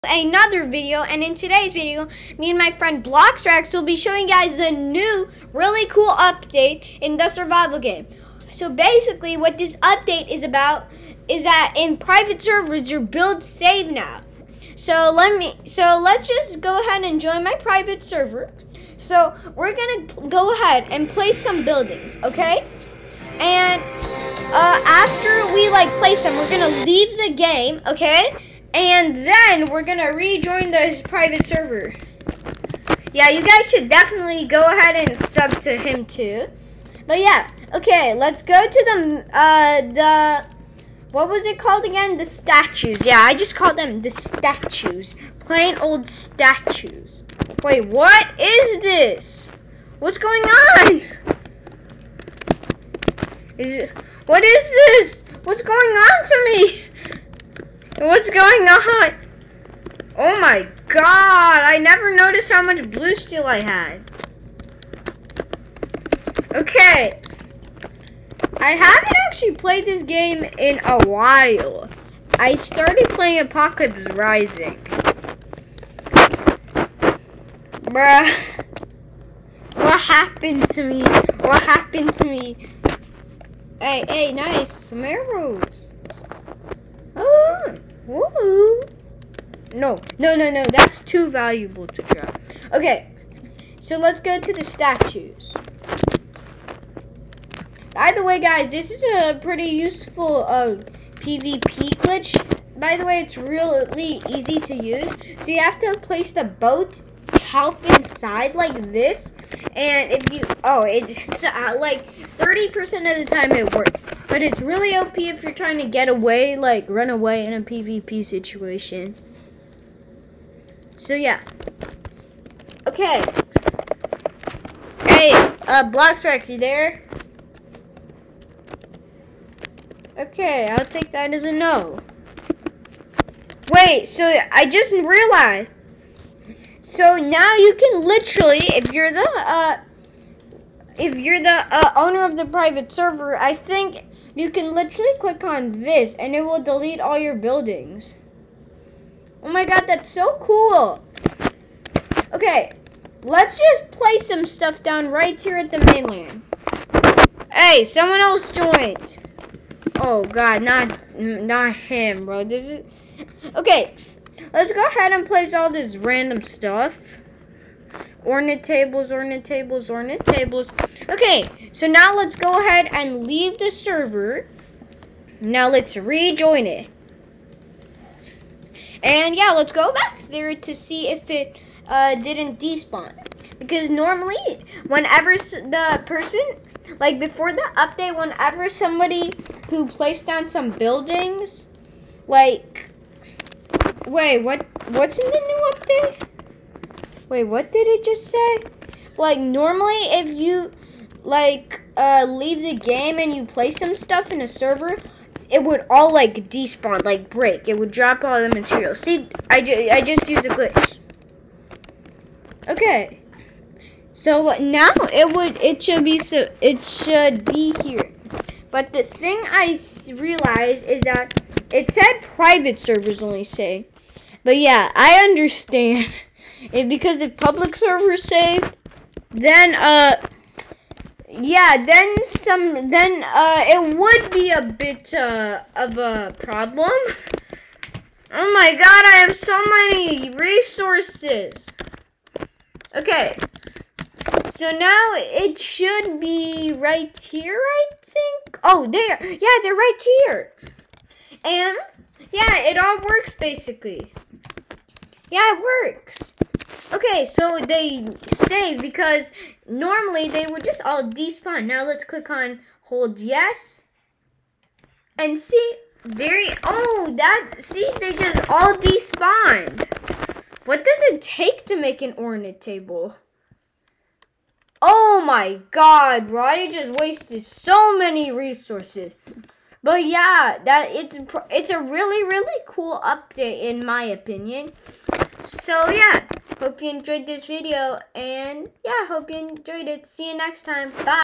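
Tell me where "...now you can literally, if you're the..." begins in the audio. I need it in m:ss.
2:17.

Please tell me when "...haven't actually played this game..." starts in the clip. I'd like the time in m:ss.
1:08.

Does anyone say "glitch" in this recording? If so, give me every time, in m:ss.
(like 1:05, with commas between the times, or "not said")
1:42, 3:30.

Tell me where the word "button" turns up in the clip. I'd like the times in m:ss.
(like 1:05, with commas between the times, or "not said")
not said.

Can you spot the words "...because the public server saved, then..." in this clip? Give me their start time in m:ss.
3:46.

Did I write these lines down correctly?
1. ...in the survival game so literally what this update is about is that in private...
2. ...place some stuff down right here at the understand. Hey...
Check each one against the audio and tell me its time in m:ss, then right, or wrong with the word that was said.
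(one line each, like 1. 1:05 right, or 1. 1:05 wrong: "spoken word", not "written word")
1. 0:07 wrong: "basically", not "literally"
2. 2:33 wrong: "mainland", not "understand".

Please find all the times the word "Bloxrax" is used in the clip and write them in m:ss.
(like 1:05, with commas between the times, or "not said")
0:03.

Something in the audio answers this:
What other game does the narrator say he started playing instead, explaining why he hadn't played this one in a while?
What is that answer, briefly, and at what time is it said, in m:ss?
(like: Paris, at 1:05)
Apocalypse Rising, at 1:13.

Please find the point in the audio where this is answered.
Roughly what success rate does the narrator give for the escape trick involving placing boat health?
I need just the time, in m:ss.
1:52.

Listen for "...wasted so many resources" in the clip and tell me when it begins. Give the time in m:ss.
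4:36.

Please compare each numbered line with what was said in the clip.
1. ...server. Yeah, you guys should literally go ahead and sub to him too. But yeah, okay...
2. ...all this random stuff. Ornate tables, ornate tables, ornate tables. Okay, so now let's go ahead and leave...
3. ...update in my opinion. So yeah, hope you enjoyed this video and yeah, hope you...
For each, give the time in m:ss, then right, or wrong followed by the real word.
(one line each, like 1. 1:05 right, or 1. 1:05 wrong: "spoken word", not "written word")
1. 0:31 wrong: "definitely", not "literally"
2. 2:45 right
3. 4:43 right.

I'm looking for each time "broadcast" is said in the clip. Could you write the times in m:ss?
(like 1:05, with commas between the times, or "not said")
not said.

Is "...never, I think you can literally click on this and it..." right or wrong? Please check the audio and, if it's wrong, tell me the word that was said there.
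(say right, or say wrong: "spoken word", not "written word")
wrong: "server", not "never".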